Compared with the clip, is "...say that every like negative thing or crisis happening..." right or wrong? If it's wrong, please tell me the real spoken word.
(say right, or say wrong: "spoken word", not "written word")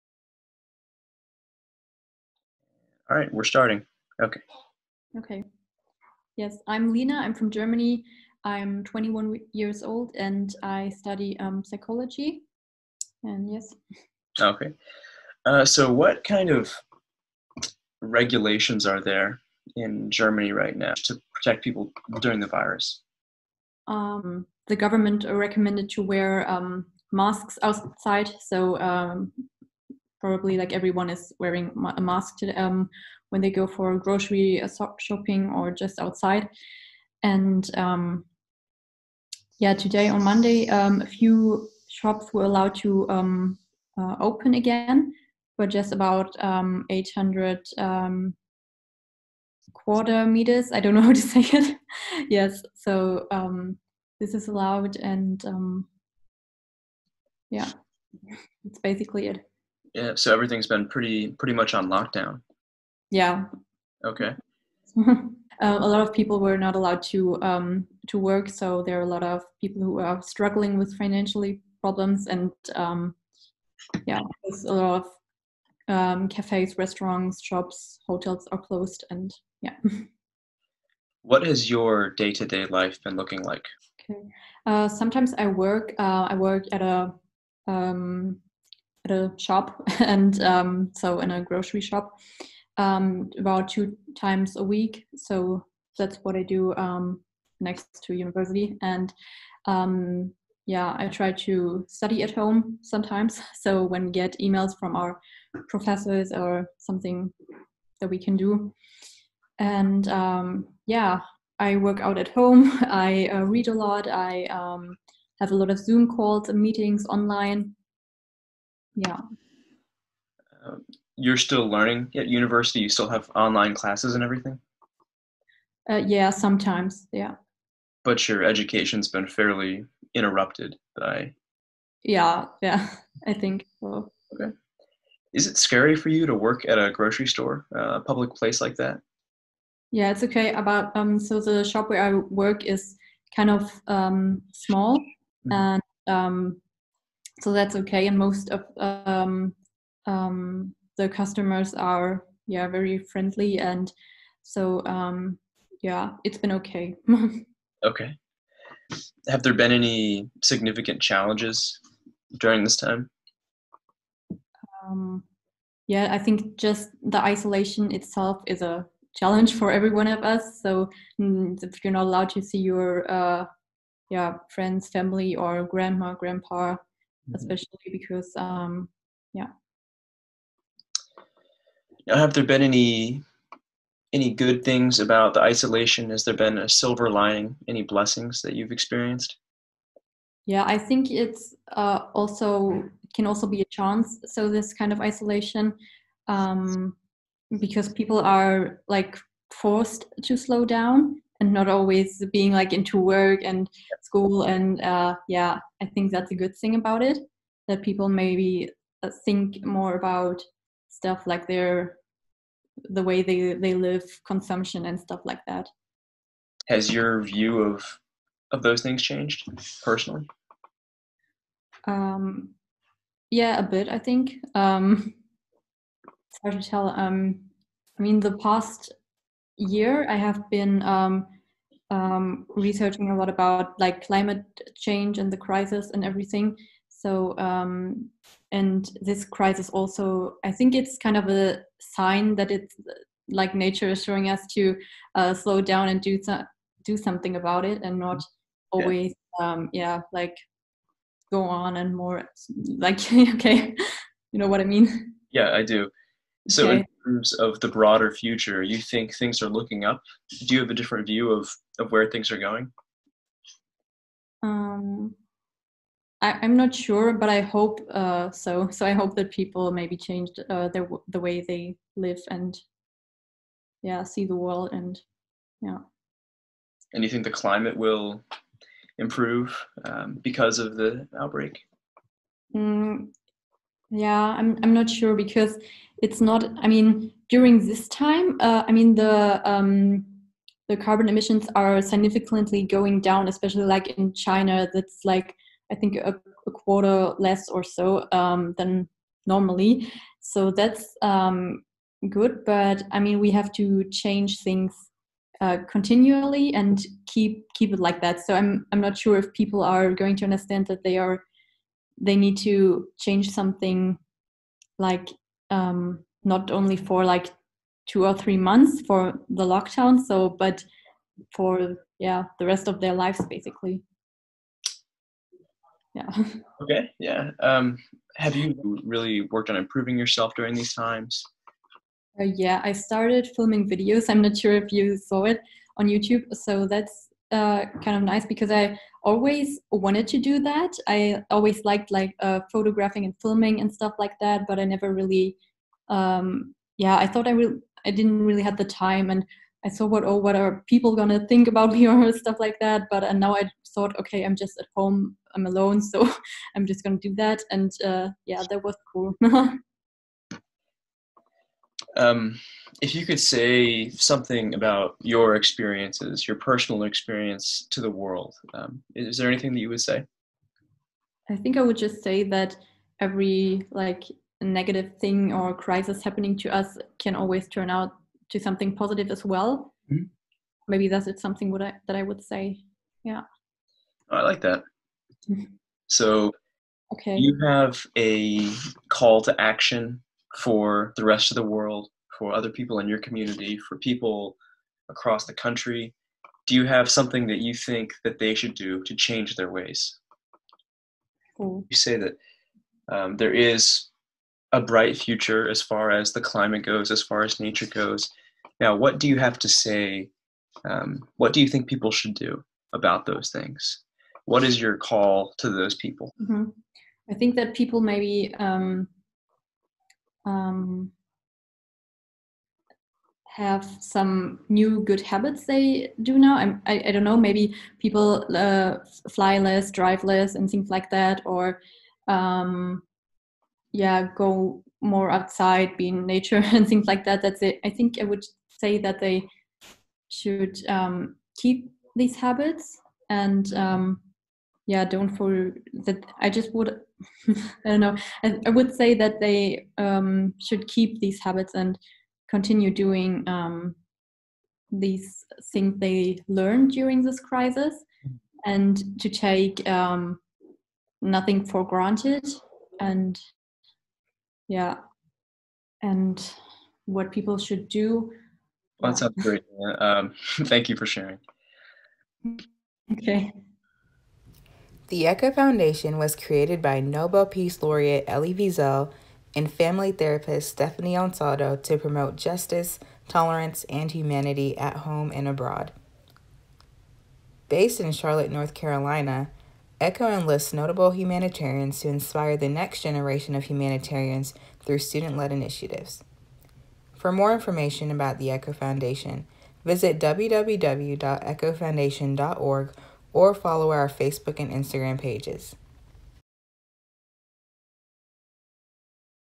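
right.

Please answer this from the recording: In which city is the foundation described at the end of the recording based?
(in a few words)
Charlotte.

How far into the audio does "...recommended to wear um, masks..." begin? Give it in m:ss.
0:25.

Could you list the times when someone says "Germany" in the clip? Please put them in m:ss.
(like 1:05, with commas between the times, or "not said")
0:07, 0:20.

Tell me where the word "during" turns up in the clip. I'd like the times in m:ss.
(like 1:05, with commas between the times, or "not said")
0:22, 2:42, 4:47, 5:30, 7:36.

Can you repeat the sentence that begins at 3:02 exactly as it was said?
Now, have there been any any good things about the isolation?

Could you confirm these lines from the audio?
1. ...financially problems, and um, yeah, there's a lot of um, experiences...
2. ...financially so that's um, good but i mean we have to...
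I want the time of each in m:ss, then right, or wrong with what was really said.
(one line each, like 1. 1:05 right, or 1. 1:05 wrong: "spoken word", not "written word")
1. 1:10 wrong: "cafes", not "experiences"
2. 4:59 wrong: "normally", not "financially".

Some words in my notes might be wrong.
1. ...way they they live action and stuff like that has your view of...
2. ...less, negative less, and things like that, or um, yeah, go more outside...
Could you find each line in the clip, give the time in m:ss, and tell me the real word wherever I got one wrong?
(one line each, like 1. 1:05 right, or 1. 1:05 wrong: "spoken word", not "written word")
1. 3:33 wrong: "consumption", not "action"
2. 7:09 wrong: "drive", not "negative".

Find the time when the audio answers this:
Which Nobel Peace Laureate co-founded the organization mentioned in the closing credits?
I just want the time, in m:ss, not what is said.
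7:58.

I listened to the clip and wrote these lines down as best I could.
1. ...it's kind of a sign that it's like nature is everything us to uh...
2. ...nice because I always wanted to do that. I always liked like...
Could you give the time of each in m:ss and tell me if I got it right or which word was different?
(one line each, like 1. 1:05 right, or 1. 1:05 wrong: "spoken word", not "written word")
1. 4:00 wrong: "showing", not "everything"
2. 5:38 right.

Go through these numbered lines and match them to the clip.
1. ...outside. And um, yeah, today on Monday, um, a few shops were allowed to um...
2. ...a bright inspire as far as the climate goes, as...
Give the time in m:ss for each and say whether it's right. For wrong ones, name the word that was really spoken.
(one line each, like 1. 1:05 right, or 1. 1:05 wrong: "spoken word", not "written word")
1. 0:35 right
2. 6:44 wrong: "future", not "inspire".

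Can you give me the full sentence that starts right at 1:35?
So that's what I do um, next to university.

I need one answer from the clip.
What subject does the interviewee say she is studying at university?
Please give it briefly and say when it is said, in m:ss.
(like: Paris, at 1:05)
Psychology, at 0:11.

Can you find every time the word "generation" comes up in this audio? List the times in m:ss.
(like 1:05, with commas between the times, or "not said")
8:12.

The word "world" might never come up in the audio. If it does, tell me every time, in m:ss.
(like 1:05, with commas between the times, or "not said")
4:34, 6:07, 6:31.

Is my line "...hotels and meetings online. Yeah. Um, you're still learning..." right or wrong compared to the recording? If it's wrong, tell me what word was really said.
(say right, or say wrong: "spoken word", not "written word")
wrong: "calls", not "hotels".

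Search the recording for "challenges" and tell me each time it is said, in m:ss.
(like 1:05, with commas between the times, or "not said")
2:41, 2:49.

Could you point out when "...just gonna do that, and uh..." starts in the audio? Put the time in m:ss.
5:56.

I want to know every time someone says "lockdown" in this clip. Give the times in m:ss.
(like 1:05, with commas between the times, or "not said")
1:01, 5:19.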